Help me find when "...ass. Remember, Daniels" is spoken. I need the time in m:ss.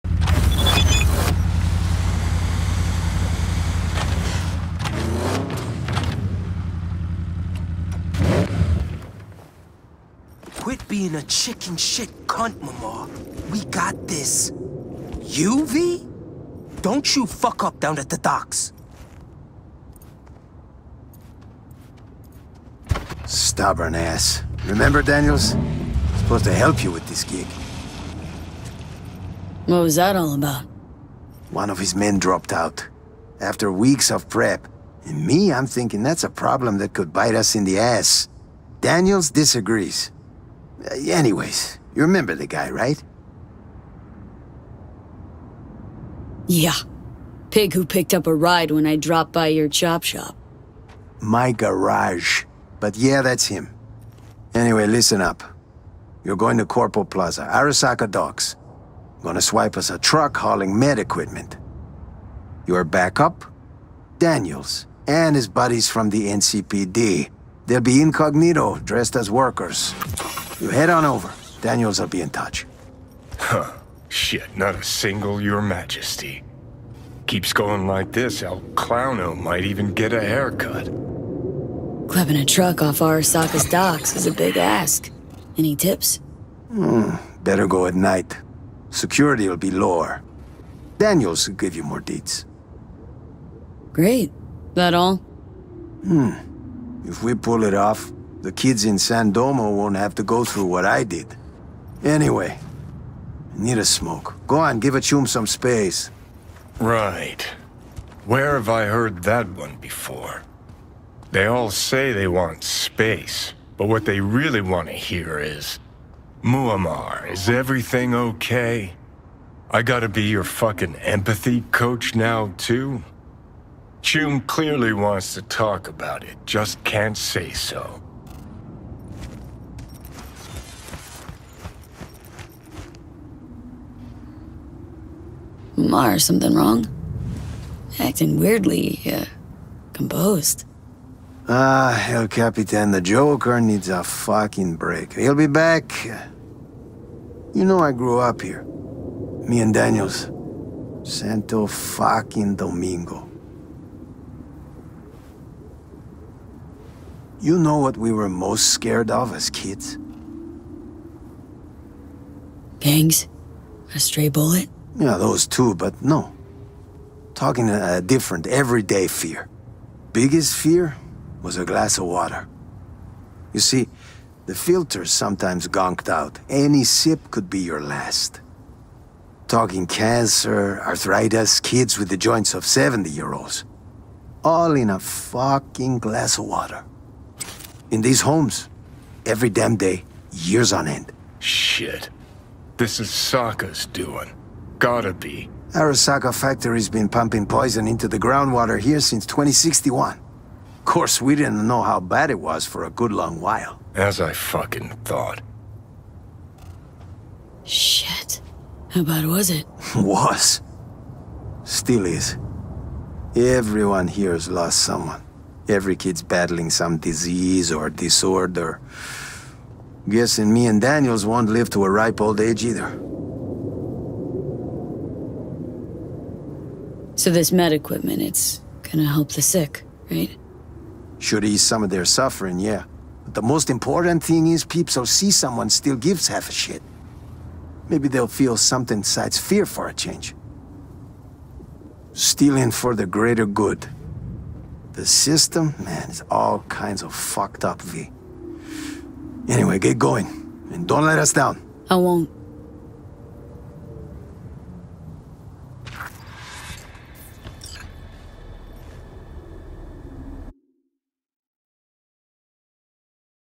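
0:23.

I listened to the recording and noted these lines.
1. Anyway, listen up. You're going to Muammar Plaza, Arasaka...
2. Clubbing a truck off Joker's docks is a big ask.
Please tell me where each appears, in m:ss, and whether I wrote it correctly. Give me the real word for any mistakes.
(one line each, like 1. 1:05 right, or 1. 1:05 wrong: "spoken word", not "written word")
1. 0:54 wrong: "Corpo", not "Muammar"
2. 1:22 wrong: "Arasaka", not "Joker".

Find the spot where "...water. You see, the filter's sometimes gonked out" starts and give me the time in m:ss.
2:52.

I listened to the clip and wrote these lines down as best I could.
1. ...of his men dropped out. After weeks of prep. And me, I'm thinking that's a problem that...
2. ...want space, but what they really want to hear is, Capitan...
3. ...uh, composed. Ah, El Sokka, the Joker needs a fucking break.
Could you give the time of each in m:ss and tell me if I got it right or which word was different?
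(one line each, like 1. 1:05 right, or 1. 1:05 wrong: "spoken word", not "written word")
1. 0:31 right
2. 1:52 wrong: "Muammar", not "Capitan"
3. 2:19 wrong: "Capitan", not "Sokka".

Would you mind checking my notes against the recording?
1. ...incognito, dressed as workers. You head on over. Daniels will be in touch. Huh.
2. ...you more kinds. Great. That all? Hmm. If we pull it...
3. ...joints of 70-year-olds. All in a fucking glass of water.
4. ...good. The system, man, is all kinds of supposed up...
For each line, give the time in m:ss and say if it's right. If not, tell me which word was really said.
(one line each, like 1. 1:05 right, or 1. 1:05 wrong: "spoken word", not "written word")
1. 1:08 right
2. 1:31 wrong: "deeds", not "kinds"
3. 3:02 right
4. 4:03 wrong: "fucked", not "supposed".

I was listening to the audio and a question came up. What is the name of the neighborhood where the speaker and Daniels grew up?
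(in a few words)
Santo Domingo.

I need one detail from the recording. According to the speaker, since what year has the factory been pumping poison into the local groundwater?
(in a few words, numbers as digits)
2061.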